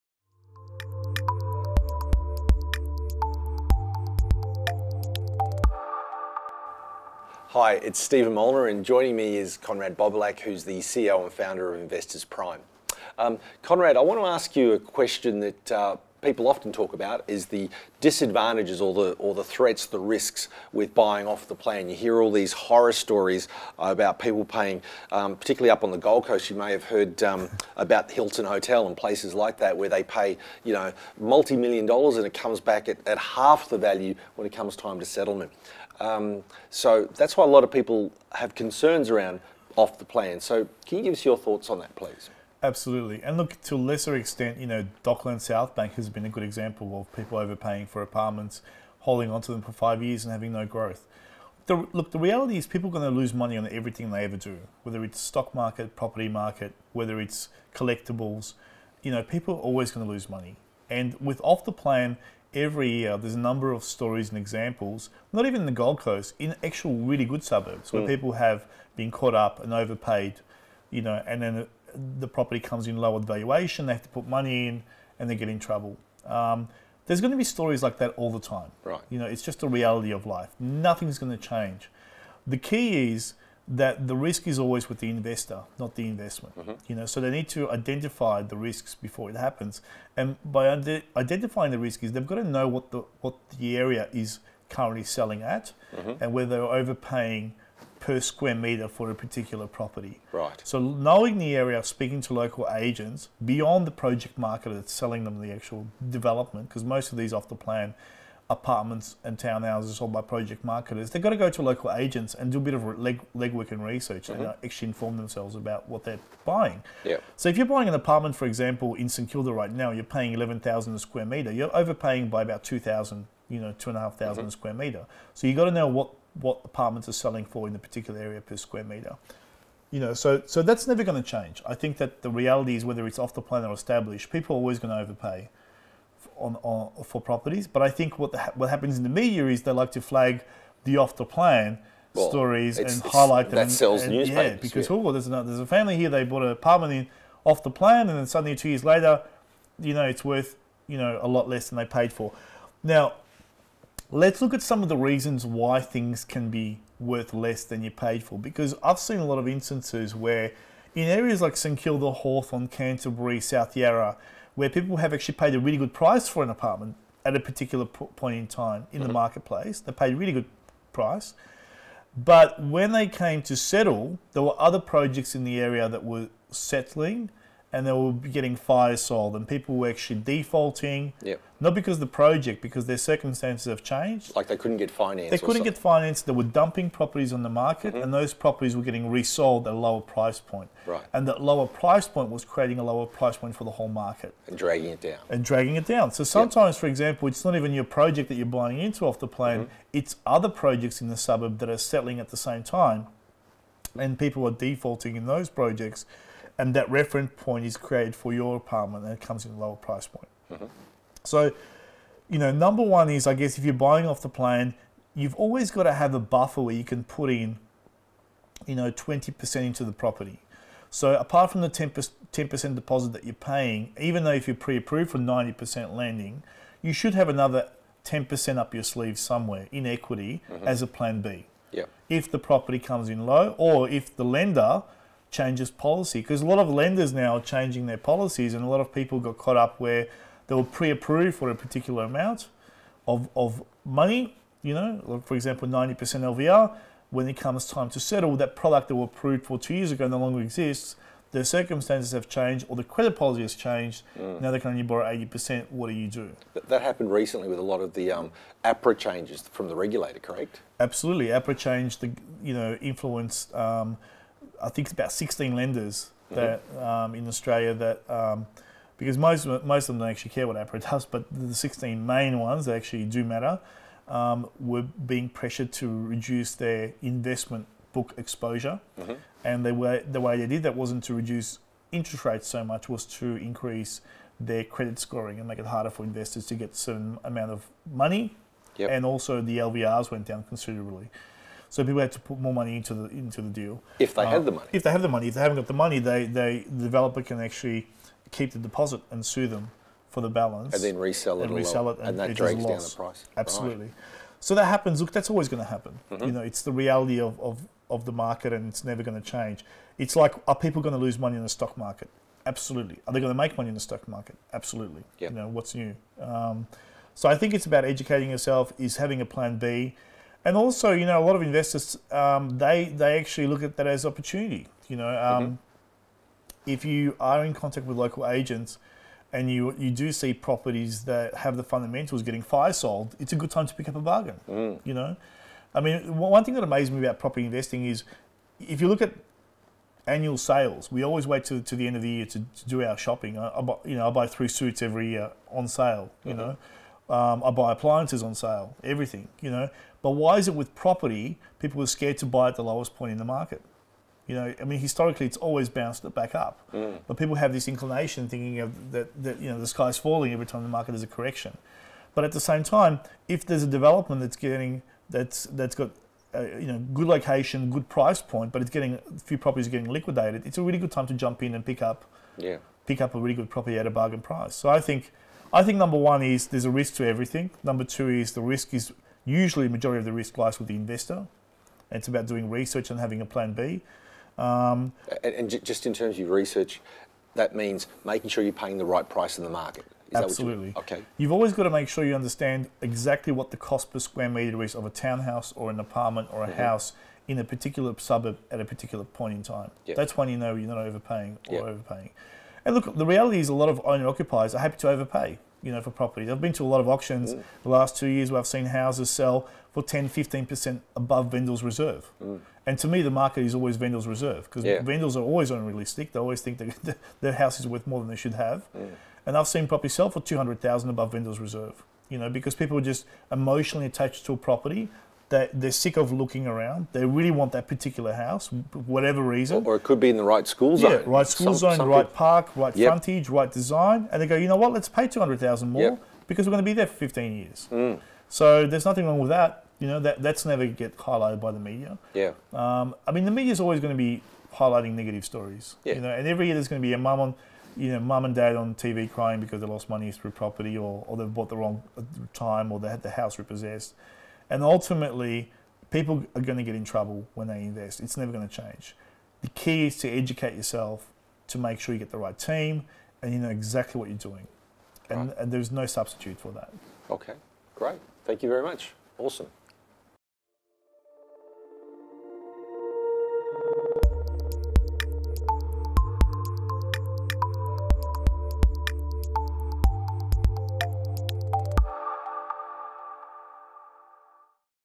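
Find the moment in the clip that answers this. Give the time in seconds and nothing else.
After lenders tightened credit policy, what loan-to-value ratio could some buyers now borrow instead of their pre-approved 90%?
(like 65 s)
255 s.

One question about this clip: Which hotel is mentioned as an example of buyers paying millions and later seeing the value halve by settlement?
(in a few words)
Hilton Hotel.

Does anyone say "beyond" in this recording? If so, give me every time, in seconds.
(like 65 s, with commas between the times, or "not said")
103 s.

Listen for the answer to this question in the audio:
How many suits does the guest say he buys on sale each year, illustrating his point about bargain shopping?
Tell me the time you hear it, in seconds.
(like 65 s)
344 s.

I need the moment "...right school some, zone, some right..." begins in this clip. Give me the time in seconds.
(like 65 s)
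431 s.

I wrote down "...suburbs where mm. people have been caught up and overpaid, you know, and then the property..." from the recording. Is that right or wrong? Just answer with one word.
right.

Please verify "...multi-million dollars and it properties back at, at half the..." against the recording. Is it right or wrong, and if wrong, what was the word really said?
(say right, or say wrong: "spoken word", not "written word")
wrong: "comes", not "properties".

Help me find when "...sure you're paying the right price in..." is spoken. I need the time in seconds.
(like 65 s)
388 s.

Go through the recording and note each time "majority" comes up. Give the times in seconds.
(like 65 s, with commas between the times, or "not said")
379 s.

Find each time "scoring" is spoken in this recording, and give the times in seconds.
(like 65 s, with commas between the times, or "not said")
284 s.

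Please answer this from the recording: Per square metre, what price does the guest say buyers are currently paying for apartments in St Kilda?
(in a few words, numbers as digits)
11,000.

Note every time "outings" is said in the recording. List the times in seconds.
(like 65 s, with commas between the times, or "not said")
not said.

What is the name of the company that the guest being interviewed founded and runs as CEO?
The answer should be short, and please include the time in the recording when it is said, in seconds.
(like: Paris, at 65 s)
Investors Prime, at 11 s.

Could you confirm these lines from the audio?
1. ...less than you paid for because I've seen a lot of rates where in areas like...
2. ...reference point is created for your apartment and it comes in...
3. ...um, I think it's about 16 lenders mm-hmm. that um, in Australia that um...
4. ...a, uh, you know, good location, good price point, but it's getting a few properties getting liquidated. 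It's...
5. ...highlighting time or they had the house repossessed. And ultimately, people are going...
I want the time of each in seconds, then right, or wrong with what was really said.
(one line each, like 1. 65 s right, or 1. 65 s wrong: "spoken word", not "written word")
1. 157 s wrong: "instances", not "rates"
2. 206 s right
3. 263 s right
4. 366 s right
5. 451 s wrong: "wrong", not "highlighting".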